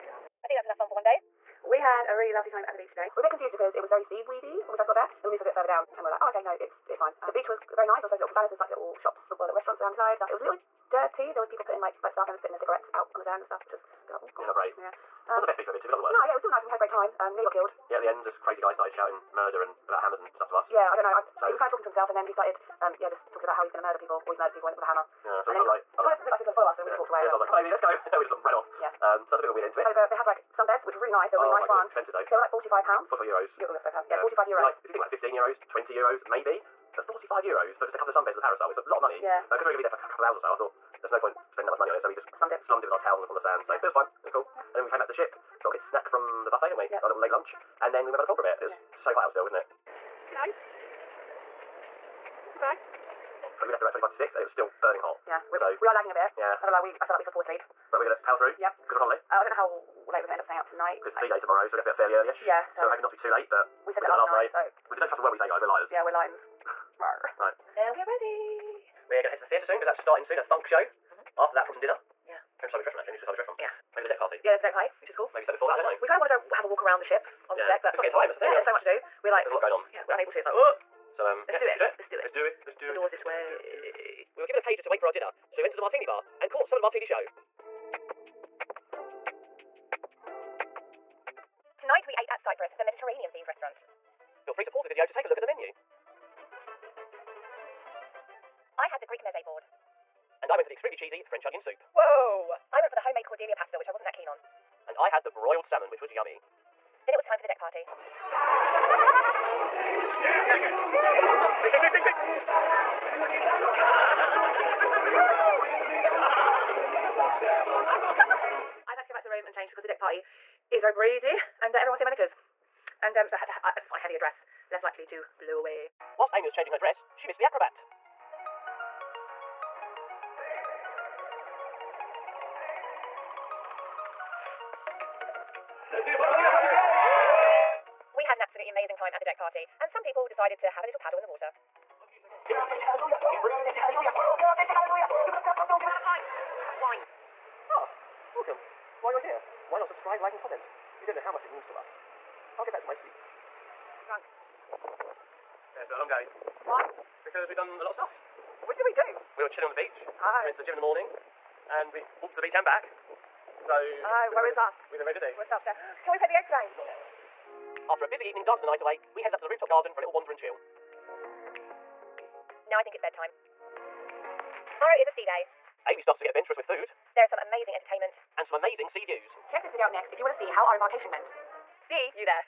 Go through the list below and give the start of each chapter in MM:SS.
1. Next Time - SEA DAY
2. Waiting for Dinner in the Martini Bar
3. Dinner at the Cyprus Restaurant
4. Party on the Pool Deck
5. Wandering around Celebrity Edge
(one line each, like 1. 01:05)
1. 02:54
2. 01:24
3. 01:31
4. 01:46
5. 02:34.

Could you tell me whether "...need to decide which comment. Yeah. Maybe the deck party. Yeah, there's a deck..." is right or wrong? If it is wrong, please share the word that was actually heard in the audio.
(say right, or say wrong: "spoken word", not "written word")
wrong: "restaurant", not "comment".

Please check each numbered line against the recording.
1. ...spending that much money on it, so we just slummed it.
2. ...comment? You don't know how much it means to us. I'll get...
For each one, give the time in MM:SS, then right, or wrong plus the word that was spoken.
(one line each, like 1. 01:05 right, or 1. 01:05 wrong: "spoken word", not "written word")
1. 00:41 right
2. 02:30 right.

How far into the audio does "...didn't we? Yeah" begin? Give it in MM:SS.
00:46.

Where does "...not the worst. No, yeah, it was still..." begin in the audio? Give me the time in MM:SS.
00:15.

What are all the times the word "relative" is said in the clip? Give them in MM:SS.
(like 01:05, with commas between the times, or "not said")
not said.